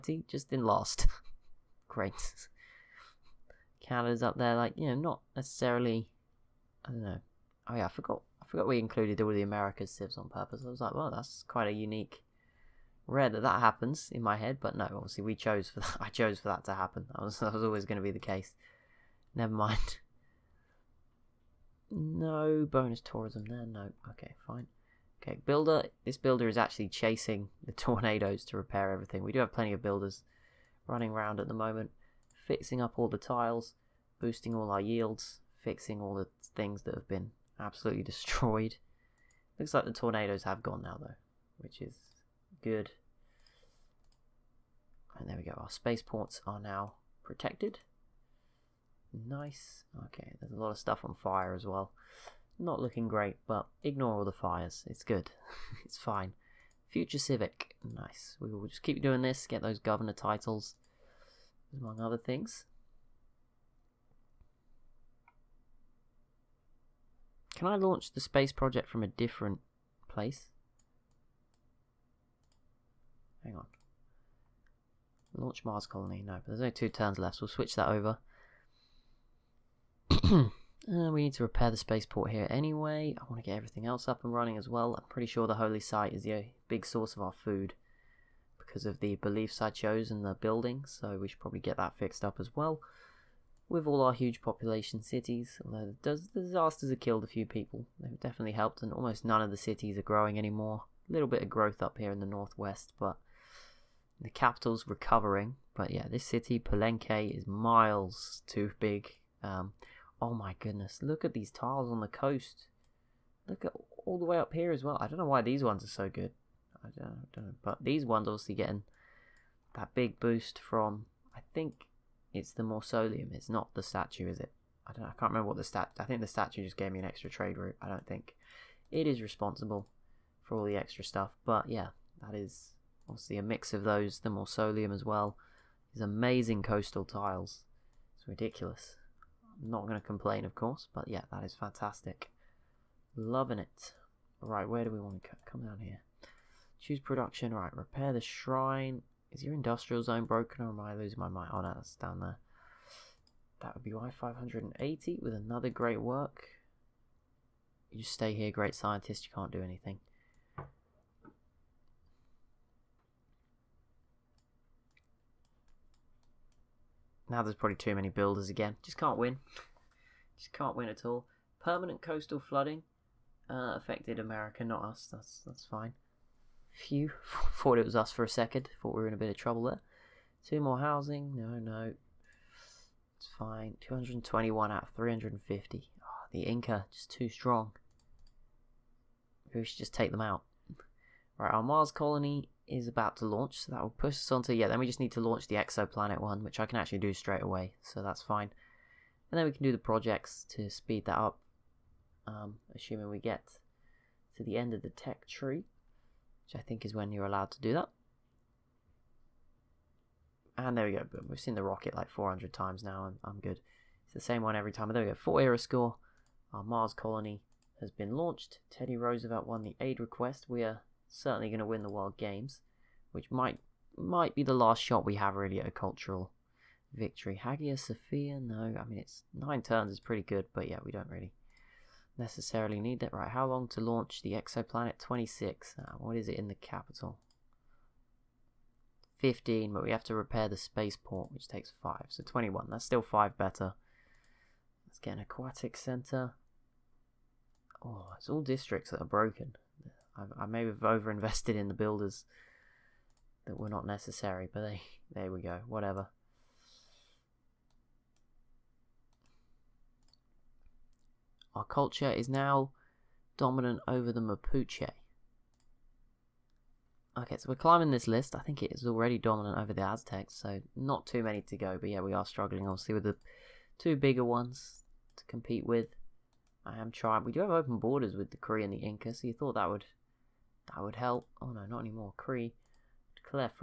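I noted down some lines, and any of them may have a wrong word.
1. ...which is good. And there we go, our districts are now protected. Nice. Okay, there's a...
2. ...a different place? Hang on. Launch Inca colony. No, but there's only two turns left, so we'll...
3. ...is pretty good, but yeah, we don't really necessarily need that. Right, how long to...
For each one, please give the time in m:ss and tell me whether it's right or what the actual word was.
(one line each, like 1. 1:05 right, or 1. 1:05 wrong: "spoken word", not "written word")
1. 0:41 wrong: "spaceports", not "districts"
2. 1:09 wrong: "Mars", not "Inca"
3. 3:49 right.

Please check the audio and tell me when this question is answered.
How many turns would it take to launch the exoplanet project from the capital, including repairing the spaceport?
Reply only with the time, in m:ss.
4:02.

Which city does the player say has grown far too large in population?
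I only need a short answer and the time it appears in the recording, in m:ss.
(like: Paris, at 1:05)
Palenque, at 1:46.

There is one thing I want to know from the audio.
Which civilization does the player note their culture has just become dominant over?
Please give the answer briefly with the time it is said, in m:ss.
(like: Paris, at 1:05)
Mapuche, at 4:24.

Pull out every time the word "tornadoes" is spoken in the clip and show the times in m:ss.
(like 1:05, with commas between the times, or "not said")
0:27, 0:39.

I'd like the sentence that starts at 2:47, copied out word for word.
Now there's probably too many builders again.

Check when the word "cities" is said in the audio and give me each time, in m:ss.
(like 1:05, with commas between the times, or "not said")
1:35, 1:39.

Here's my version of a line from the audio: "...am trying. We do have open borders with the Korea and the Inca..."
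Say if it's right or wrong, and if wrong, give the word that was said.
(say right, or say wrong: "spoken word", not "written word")
right.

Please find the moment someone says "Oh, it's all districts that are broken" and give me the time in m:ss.
4:07.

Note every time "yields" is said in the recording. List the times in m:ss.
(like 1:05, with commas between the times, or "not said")
0:34.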